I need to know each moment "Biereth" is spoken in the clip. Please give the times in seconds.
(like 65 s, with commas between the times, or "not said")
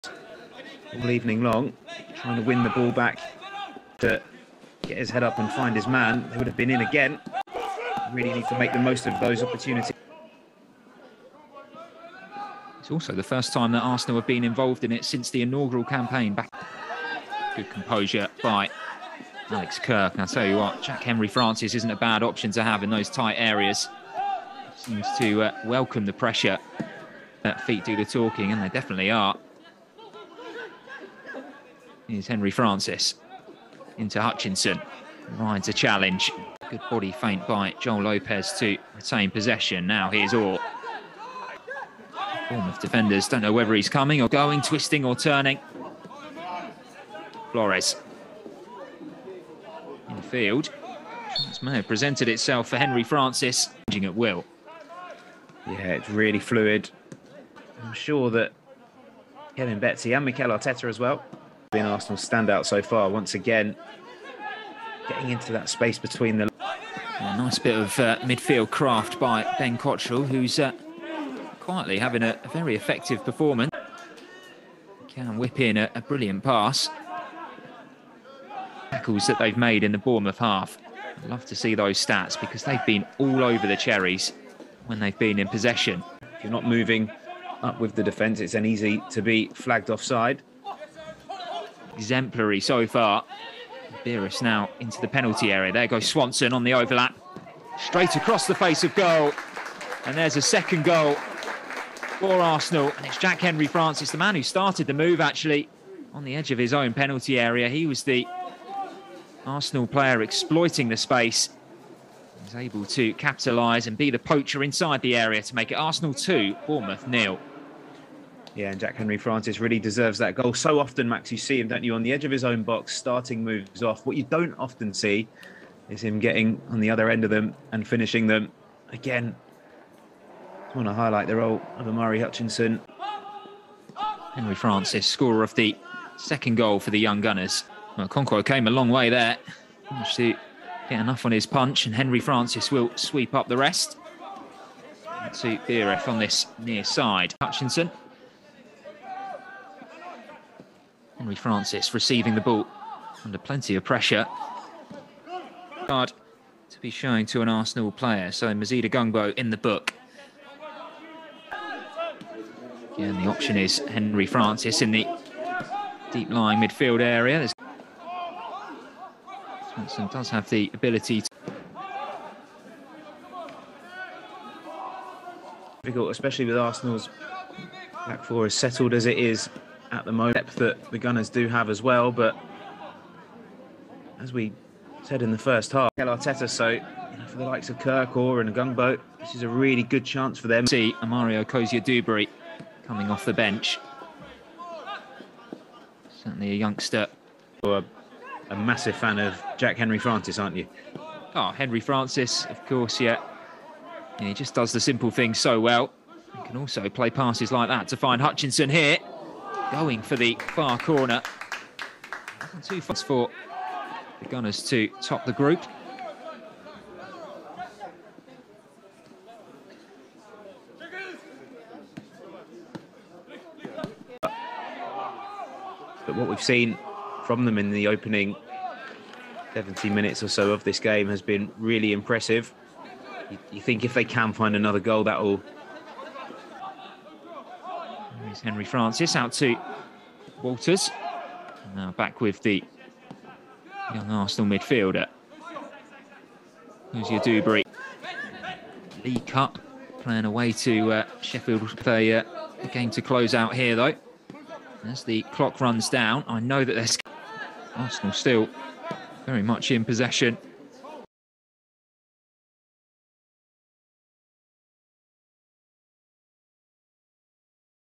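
94 s.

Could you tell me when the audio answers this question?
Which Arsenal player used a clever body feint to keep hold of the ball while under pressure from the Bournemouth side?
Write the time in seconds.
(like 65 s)
37 s.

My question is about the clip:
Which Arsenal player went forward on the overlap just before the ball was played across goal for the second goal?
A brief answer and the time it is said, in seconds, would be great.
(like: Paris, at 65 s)
Swanson, at 96 s.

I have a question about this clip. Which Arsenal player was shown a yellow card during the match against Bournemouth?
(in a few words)
Mazeed Ogungbo.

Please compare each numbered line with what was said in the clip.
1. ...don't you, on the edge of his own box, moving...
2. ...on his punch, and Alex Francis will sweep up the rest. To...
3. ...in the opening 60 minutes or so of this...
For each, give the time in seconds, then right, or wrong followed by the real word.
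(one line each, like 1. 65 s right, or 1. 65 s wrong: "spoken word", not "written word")
1. 121 s wrong: "starting", not "moving"
2. 141 s wrong: "Henry", not "Alex"
3. 227 s wrong: "70", not "60".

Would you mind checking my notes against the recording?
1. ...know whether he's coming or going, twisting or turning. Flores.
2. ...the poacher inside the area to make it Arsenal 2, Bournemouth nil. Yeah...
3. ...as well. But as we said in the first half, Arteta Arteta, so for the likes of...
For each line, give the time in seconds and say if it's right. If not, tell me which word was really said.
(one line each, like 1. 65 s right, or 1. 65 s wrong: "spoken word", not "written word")
1. 43 s right
2. 114 s right
3. 181 s wrong: "Mikel", not "Arteta".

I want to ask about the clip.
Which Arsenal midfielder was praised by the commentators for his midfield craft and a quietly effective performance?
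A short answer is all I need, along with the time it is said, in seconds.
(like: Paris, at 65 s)
Ben Cottrell, at 69 s.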